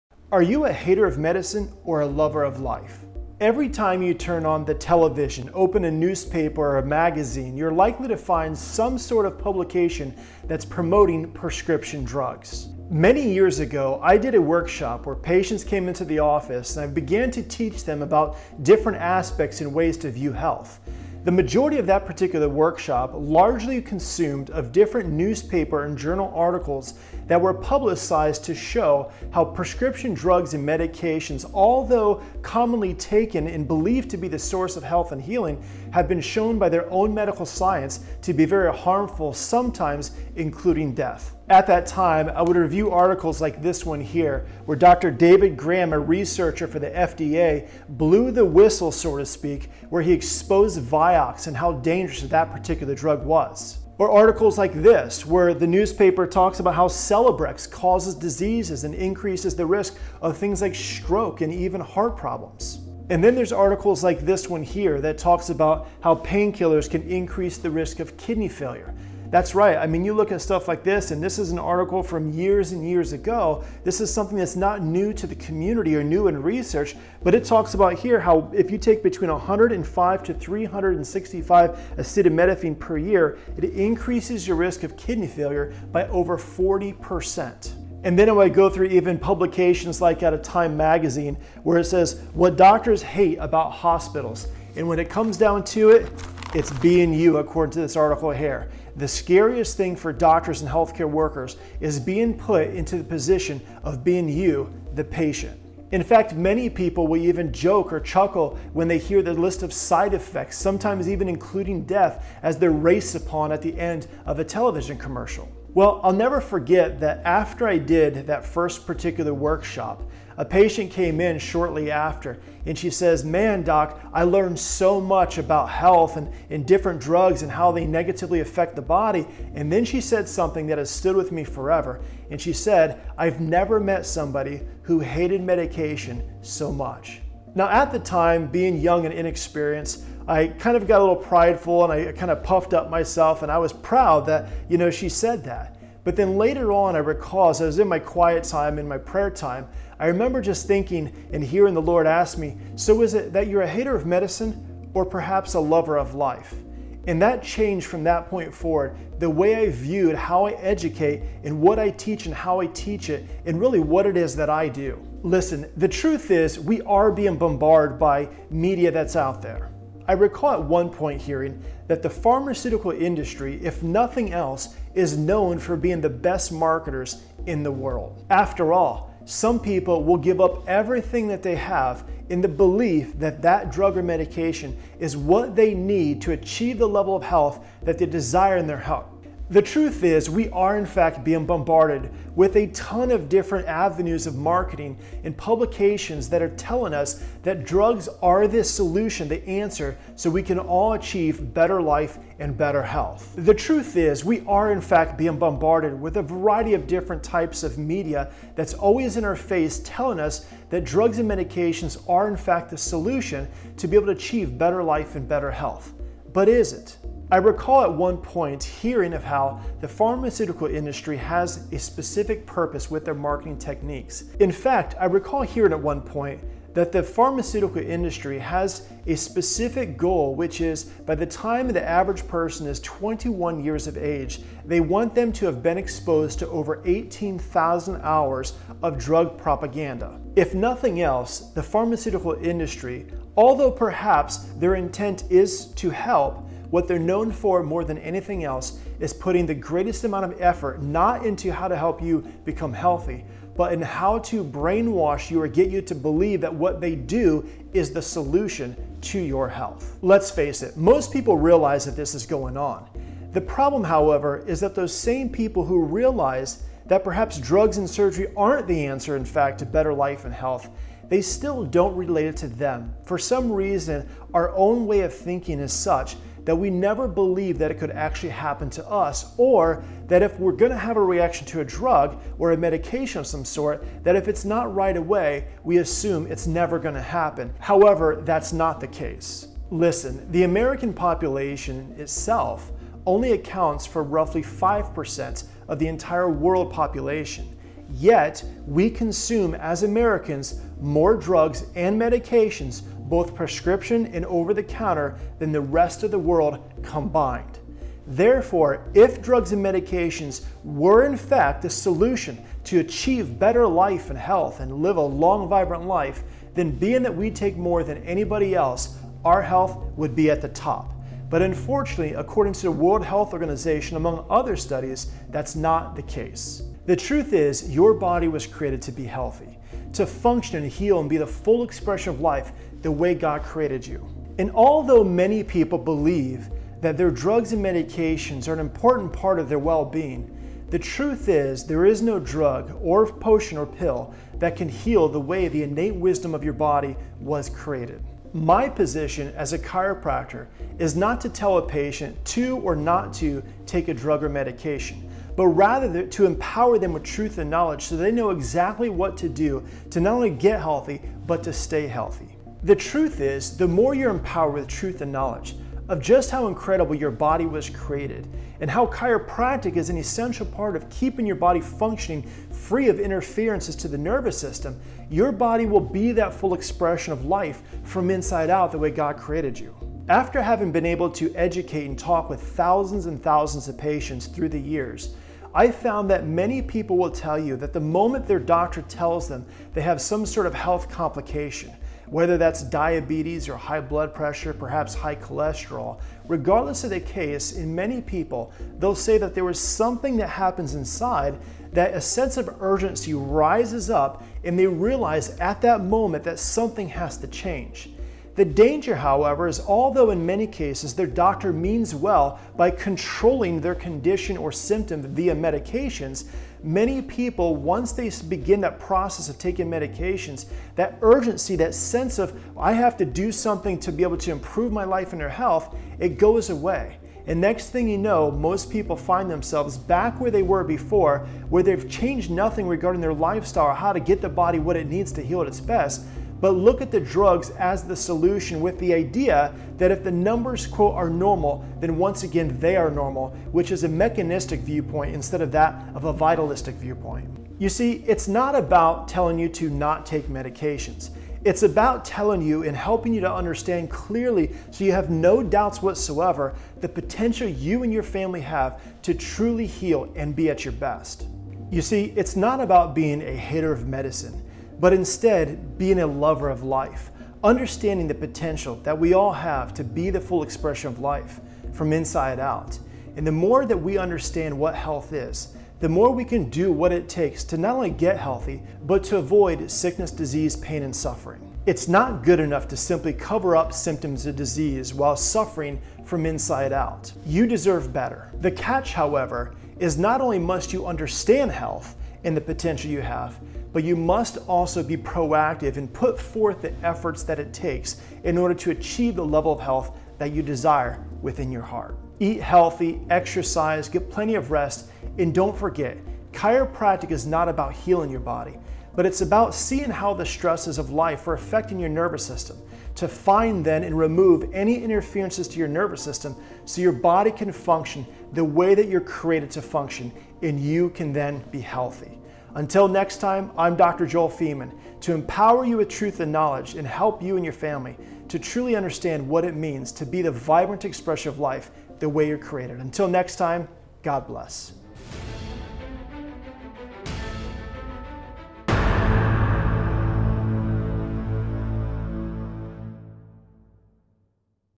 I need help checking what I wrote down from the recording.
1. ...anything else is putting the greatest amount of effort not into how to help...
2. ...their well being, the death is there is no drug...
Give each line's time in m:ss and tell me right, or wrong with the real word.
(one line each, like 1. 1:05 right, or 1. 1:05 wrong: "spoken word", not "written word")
1. 4:07 right
2. 5:39 wrong: "truth", not "death".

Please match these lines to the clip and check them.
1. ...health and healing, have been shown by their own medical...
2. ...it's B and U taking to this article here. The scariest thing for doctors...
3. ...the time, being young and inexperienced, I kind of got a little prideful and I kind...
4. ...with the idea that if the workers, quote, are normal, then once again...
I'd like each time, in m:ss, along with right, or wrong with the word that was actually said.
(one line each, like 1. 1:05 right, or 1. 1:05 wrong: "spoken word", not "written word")
1. 0:34 right
2. 1:36 wrong: "according", not "taking"
3. 2:17 right
4. 7:18 wrong: "numbers", not "workers".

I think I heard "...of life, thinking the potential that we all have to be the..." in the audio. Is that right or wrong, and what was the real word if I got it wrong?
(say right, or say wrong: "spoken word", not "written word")
wrong: "understanding", not "thinking".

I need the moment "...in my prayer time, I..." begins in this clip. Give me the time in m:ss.
2:28.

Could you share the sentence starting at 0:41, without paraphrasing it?
At that time, I would review articles like this one here, where Dr.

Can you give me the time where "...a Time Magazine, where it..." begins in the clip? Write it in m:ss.
1:30.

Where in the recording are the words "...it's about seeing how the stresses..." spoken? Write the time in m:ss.
8:29.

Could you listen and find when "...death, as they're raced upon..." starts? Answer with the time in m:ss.
1:51.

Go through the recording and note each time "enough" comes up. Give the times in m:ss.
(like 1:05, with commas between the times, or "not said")
8:02.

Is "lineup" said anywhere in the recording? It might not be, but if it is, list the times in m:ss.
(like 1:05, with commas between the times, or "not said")
not said.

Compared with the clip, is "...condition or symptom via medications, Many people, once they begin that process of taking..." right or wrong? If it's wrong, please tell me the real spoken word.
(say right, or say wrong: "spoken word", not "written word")
right.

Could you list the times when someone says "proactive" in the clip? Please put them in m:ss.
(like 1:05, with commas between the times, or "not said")
8:14.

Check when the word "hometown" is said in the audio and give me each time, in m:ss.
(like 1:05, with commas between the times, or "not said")
not said.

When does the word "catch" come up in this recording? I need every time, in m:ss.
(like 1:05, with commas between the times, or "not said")
8:08.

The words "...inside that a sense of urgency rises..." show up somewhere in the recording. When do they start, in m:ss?
6:40.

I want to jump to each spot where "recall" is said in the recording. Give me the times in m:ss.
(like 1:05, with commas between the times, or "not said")
2:26, 2:50, 3:37, 3:45.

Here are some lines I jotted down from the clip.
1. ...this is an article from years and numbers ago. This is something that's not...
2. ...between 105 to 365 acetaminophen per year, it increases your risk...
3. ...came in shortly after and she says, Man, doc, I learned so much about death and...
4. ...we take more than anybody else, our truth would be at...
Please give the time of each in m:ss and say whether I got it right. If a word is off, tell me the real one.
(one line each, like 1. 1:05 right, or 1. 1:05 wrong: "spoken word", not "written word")
1. 1:11 wrong: "years", not "numbers"
2. 1:19 right
3. 2:00 wrong: "health", not "death"
4. 5:17 wrong: "health", not "truth".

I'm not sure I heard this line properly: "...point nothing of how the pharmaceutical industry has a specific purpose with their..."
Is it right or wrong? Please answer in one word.
wrong.